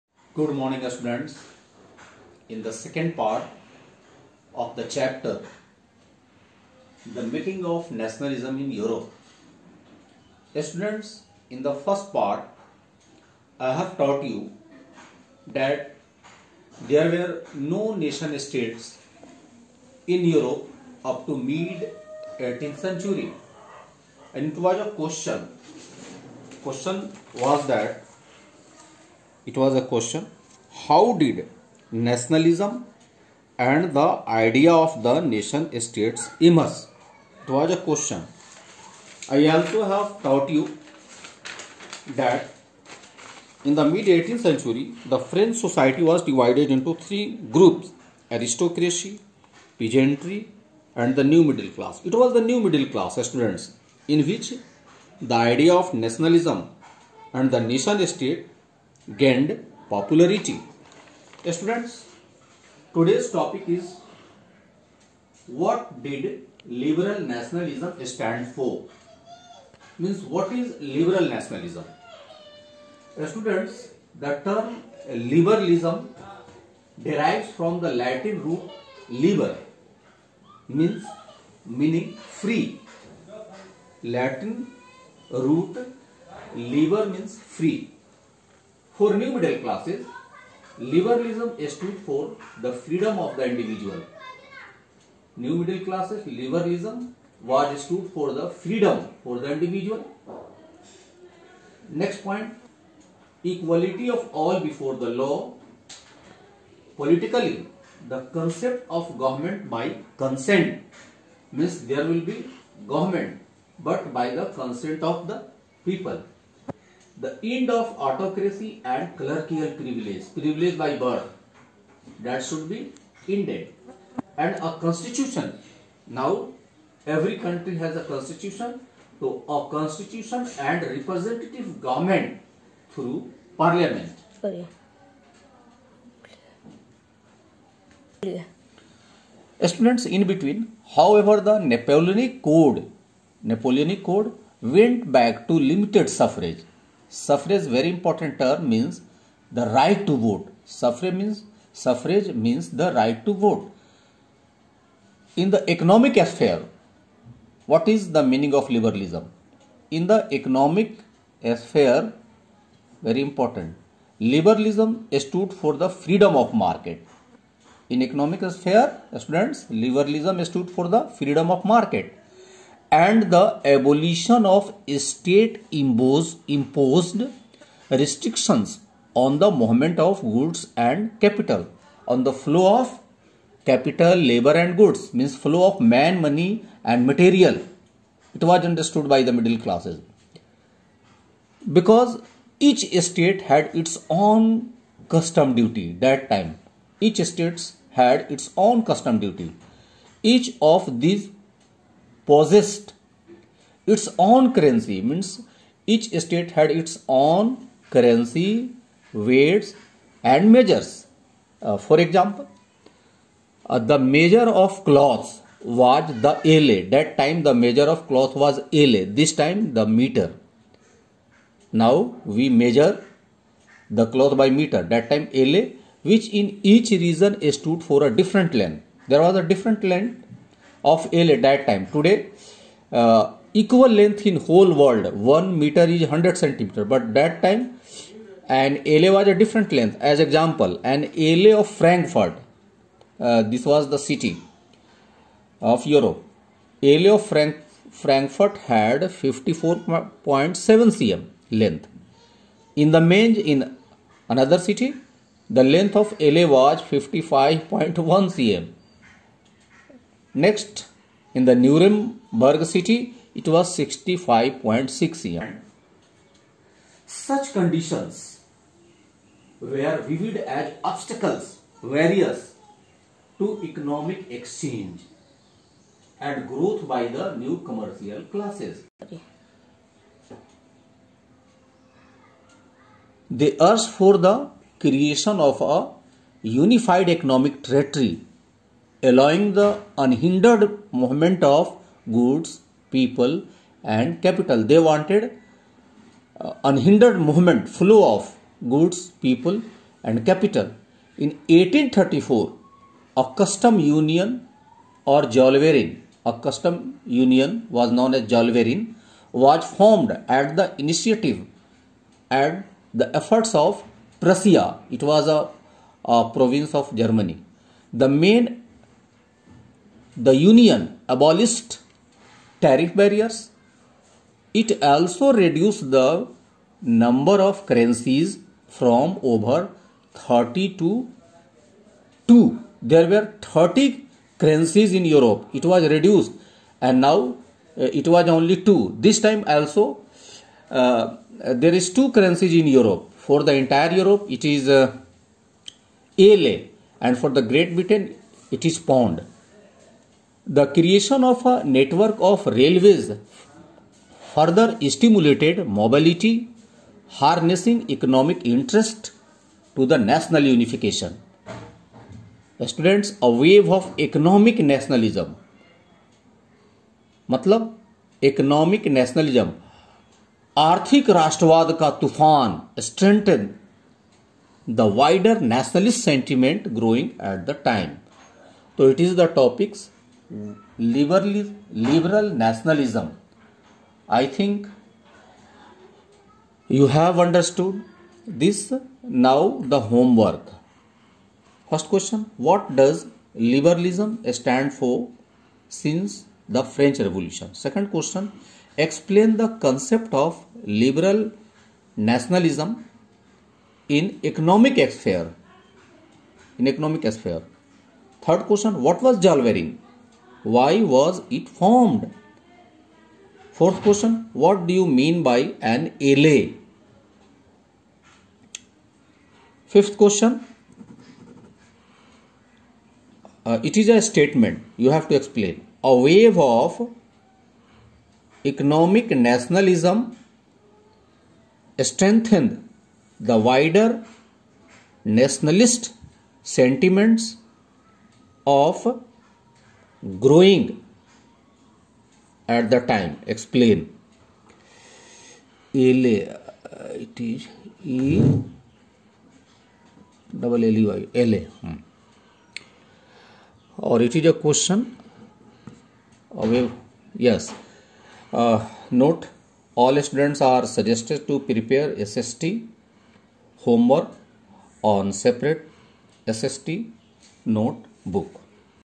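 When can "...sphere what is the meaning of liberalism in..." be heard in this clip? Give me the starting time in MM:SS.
02:36.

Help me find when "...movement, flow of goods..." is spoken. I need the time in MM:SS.
04:57.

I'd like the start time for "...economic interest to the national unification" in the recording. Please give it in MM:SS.
05:57.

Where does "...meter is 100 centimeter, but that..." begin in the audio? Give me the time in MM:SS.
03:55.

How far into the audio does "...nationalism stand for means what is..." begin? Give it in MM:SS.
01:07.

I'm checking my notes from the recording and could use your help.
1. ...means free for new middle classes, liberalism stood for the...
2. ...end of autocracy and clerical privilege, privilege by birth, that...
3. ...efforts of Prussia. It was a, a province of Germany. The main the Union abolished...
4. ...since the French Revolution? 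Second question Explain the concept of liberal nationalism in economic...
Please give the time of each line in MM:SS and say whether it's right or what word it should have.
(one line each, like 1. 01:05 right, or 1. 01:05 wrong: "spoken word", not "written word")
1. 01:27 right
2. 01:57 right
3. 05:13 right
4. 06:35 right.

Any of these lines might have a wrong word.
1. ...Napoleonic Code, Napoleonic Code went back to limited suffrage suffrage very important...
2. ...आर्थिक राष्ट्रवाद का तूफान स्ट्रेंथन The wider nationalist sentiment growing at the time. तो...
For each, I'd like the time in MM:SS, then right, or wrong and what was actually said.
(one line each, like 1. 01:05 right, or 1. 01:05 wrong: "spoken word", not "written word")
1. 02:21 right
2. 06:10 right.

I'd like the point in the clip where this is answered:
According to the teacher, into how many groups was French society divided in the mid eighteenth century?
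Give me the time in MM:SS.
00:47.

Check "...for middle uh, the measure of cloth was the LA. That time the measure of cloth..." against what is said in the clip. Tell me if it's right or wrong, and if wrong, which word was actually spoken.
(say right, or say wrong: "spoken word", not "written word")
wrong: "example", not "middle".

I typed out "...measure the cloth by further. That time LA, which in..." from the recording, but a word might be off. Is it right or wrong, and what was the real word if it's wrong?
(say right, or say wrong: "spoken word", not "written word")
wrong: "meter", not "further".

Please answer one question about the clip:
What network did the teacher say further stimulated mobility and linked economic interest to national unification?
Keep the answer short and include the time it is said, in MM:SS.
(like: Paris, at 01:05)
railways, at 05:52.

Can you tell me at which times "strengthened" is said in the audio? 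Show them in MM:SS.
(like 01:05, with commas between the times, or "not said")
07:11.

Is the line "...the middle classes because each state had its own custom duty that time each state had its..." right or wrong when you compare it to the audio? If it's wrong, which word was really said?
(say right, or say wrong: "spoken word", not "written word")
right.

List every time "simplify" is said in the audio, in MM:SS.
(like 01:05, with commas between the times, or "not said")
not said.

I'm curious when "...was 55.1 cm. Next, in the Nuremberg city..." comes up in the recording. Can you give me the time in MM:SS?
04:16.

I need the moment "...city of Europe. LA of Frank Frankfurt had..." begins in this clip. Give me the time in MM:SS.
04:03.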